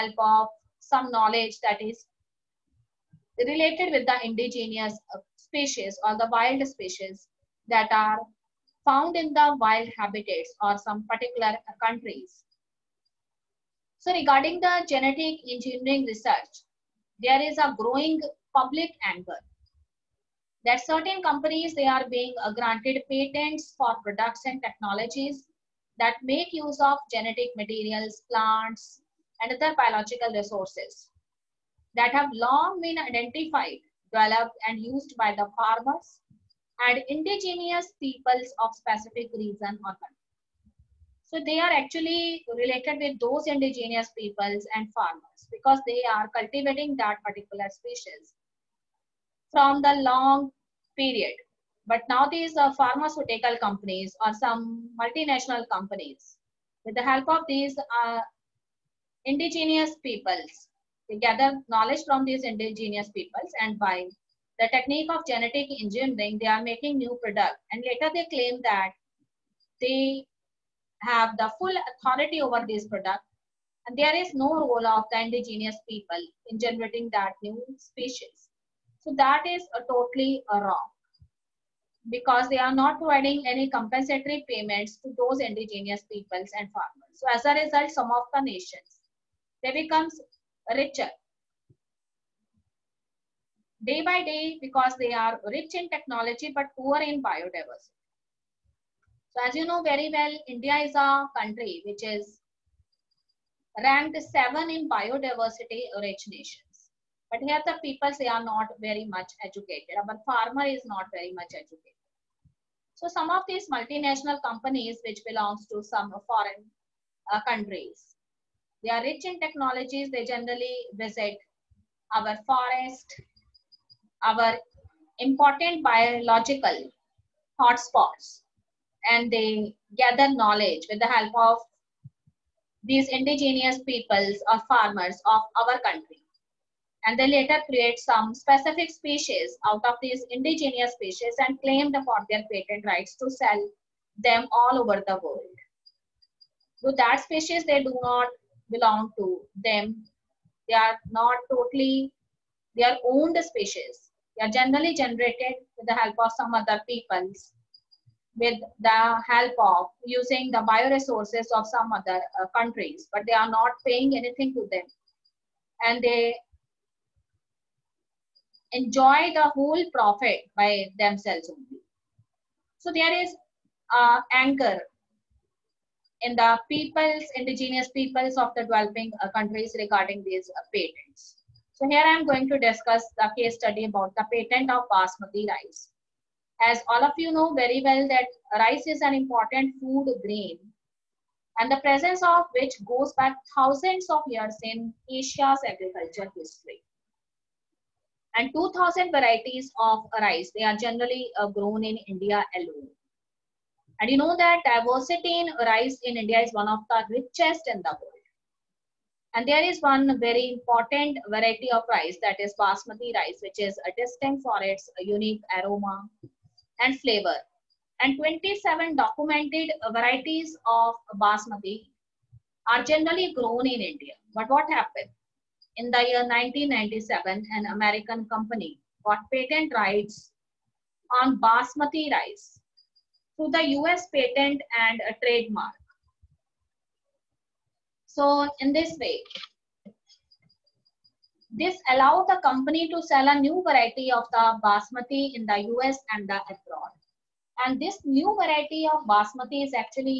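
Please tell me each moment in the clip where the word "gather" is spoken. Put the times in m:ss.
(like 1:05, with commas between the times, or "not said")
1:01, 2:09.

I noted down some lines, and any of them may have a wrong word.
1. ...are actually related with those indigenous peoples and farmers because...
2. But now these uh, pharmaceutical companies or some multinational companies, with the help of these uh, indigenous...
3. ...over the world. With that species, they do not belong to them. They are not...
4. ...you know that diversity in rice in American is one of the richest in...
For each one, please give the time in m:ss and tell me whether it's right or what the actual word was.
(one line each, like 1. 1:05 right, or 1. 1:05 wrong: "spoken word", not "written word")
1. 0:41 right
2. 0:51 right
3. 2:24 right
4. 3:24 wrong: "India", not "American".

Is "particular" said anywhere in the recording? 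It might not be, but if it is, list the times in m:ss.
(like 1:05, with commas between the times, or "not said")
0:11, 0:47.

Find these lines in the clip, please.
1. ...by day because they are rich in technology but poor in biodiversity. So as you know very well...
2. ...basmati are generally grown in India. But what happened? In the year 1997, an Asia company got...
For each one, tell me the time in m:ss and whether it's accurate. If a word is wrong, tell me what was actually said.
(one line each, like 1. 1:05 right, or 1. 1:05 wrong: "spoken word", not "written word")
1. 1:34 right
2. 3:41 wrong: "American", not "Asia".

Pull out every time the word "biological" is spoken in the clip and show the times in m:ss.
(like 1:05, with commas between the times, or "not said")
0:29, 2:05.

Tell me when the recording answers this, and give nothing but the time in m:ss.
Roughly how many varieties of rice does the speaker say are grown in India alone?
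3:18.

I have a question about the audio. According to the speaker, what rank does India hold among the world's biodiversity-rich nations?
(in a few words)
7.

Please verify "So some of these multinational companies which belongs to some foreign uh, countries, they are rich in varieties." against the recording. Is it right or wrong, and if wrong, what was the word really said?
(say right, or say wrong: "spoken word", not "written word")
wrong: "technologies", not "varieties".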